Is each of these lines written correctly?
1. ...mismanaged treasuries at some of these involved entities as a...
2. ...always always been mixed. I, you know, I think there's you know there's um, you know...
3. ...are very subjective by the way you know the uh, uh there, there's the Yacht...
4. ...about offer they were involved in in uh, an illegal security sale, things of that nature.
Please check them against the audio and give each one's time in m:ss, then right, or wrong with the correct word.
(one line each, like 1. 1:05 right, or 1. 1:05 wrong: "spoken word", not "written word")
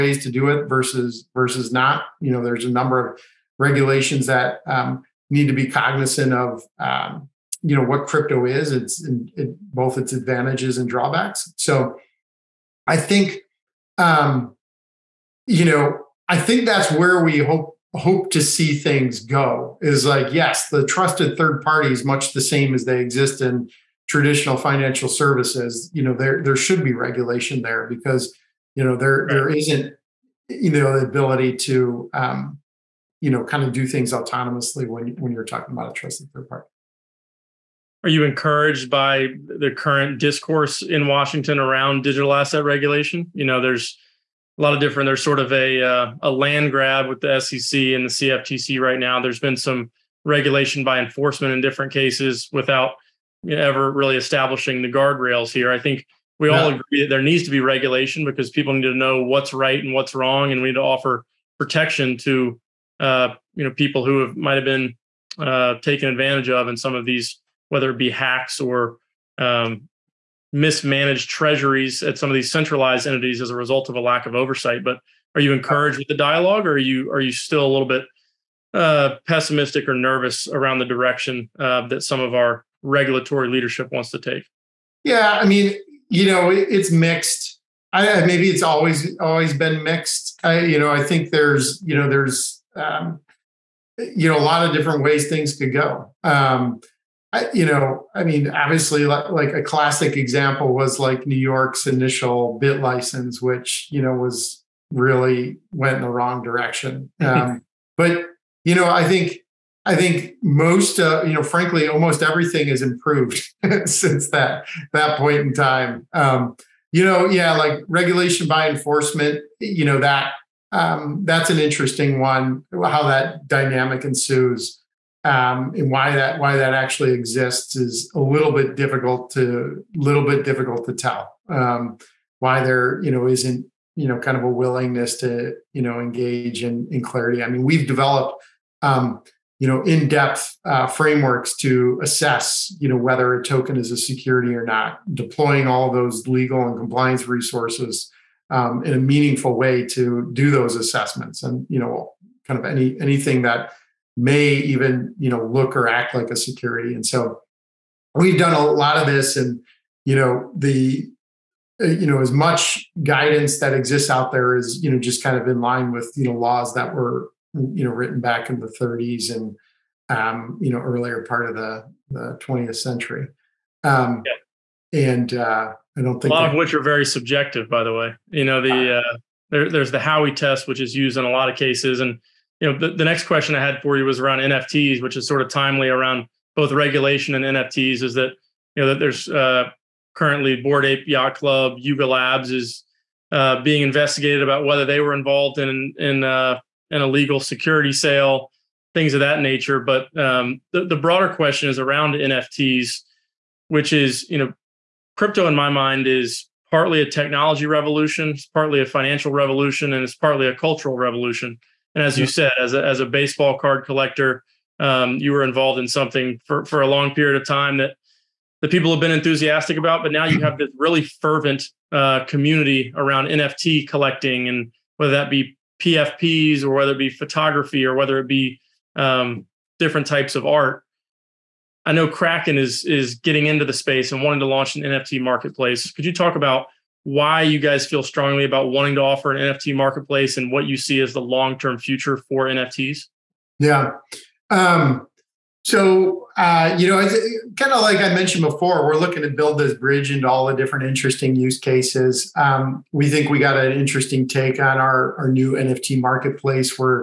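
1. 1:10 wrong: "centralized", not "involved"
2. 1:28 right
3. 2:56 wrong: "Howey", not "Yacht"
4. 3:14 wrong: "whether", not "offer".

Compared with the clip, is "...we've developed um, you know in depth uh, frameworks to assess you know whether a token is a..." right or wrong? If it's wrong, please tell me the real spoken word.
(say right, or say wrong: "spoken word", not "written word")
right.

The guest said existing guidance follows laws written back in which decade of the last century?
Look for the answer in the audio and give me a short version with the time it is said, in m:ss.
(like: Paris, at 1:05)
the 30s, at 2:48.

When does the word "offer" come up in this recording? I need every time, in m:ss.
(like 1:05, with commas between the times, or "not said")
1:00, 3:58.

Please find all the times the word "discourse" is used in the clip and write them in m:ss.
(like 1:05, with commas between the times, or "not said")
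0:40.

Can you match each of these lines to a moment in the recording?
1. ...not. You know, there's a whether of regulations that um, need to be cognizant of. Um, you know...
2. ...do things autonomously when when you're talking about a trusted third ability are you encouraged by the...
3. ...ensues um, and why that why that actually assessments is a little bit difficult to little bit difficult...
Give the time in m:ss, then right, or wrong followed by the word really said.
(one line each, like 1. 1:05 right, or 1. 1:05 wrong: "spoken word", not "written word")
1. 0:01 wrong: "number", not "whether"
2. 0:33 wrong: "party", not "ability"
3. 2:04 wrong: "exists", not "assessments".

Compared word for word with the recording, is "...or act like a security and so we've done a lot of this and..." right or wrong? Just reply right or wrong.
right.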